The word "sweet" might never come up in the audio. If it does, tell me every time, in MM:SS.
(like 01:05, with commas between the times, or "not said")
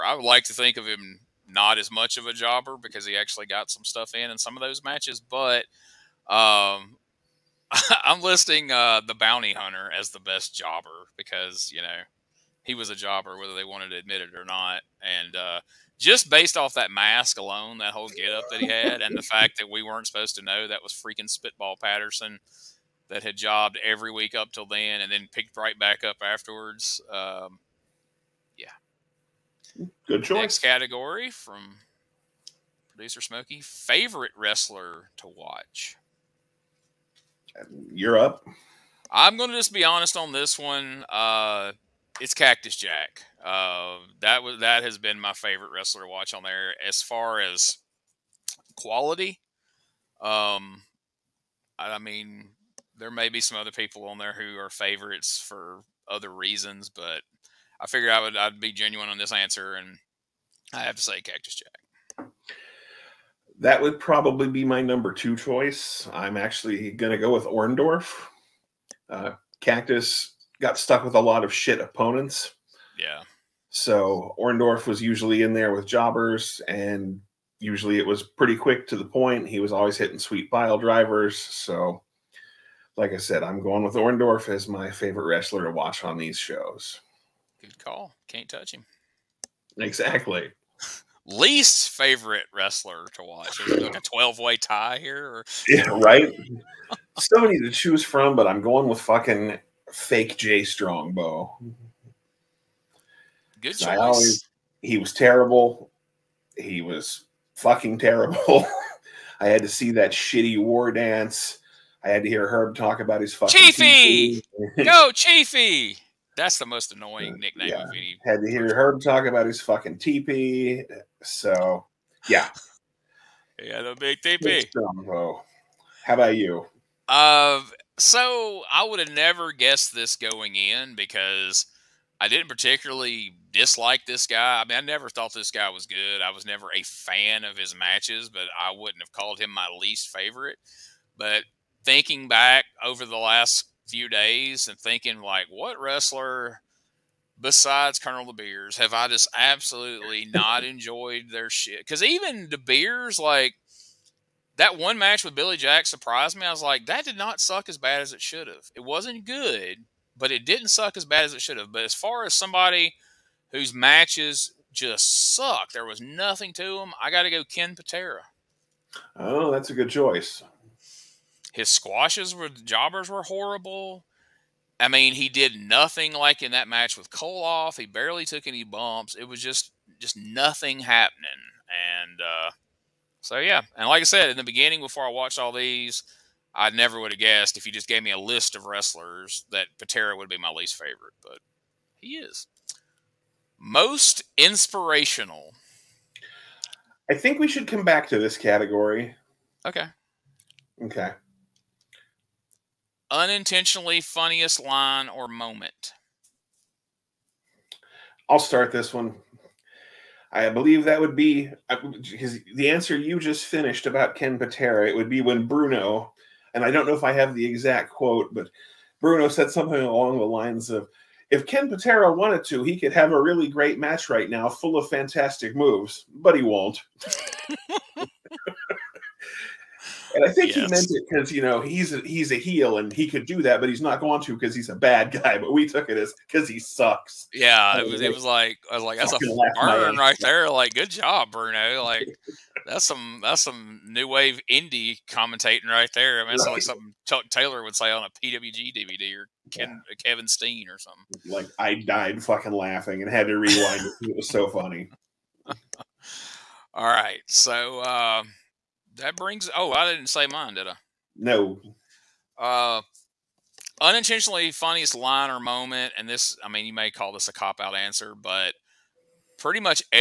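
01:20.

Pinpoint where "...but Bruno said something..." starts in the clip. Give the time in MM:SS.
03:38.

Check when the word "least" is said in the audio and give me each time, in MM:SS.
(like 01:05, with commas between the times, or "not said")
01:31, 02:19, 03:10.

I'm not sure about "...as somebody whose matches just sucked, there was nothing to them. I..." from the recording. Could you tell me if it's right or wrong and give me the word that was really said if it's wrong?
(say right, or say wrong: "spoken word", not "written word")
right.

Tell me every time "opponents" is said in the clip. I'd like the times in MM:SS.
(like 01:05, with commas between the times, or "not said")
01:11.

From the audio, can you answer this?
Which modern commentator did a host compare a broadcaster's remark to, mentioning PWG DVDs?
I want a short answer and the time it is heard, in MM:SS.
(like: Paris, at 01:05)
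Chuck Taylor, at 04:07.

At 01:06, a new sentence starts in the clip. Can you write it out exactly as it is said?
I'm actually going to go with Orndorff.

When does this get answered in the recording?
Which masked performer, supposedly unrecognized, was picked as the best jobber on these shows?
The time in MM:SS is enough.
00:21.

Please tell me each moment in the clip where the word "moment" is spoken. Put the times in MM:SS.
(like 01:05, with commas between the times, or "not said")
03:25, 04:25.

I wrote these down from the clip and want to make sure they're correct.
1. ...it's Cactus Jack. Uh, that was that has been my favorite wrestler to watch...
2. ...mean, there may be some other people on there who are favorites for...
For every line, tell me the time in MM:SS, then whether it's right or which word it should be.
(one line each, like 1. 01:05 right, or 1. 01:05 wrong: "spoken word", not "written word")
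1. 00:42 right
2. 00:51 right.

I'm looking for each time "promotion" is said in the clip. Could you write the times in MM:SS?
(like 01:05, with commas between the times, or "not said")
not said.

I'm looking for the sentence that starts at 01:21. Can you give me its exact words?
So, like I said, I'm going with Orndorff as my favorite wrestler to watch on these shows.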